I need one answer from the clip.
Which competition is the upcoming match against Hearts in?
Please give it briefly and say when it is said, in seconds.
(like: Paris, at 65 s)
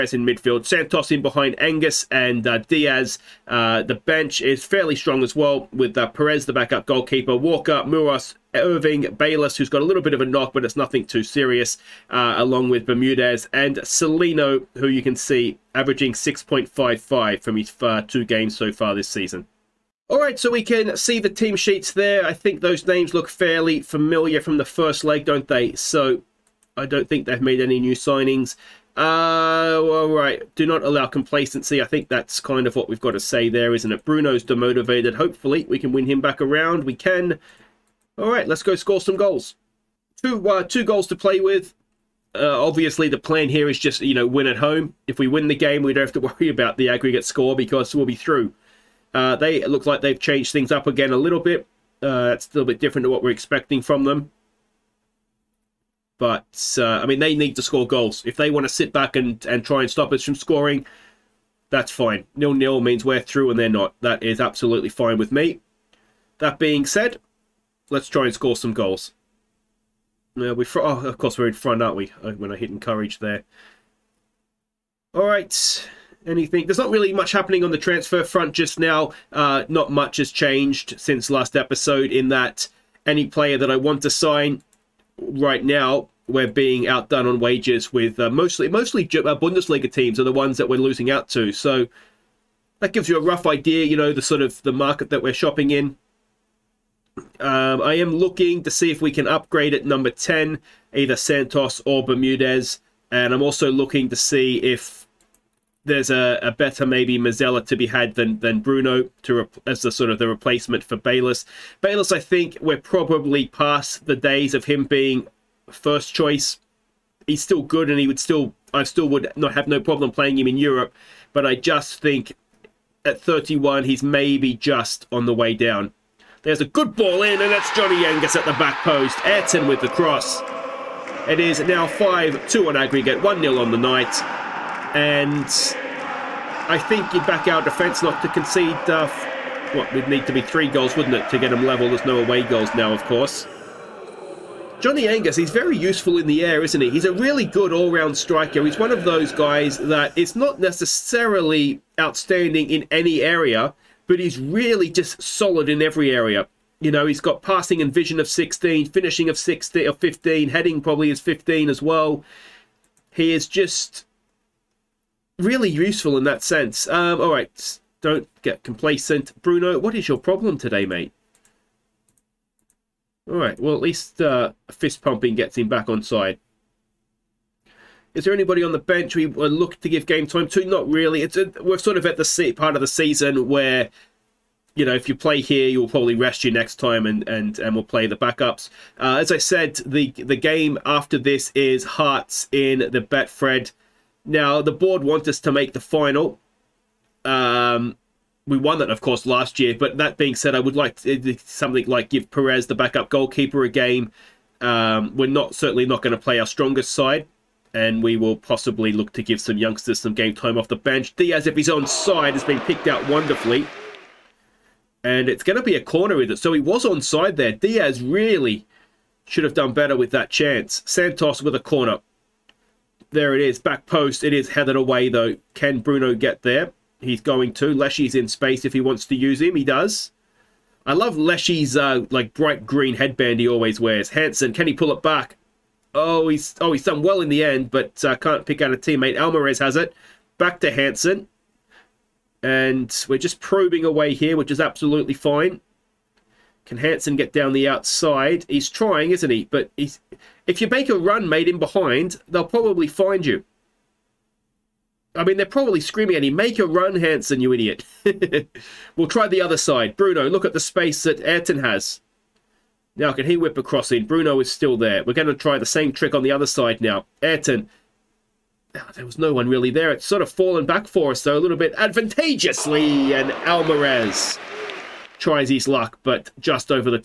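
Betfred, at 193 s.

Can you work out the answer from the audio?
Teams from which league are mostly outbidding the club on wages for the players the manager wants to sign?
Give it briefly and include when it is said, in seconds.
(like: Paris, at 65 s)
Bundesliga, at 89 s.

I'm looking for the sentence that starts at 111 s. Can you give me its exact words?
Bayless, I think we're probably past the days of him being first choice.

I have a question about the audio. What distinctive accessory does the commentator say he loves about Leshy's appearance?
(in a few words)
Bright green headband.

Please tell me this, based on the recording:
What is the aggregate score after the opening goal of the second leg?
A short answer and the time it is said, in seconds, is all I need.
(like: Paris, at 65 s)
5-2, at 131 s.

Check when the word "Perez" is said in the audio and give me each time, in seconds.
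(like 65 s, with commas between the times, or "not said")
6 s, 202 s.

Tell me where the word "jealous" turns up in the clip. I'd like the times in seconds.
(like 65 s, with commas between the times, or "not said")
not said.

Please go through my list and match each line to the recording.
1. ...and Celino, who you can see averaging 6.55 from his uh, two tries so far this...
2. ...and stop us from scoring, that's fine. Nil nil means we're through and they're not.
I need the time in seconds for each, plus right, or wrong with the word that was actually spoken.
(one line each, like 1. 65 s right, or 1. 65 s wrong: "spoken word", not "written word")
1. 13 s wrong: "games", not "tries"
2. 59 s right.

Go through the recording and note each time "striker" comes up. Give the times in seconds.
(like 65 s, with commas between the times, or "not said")
148 s.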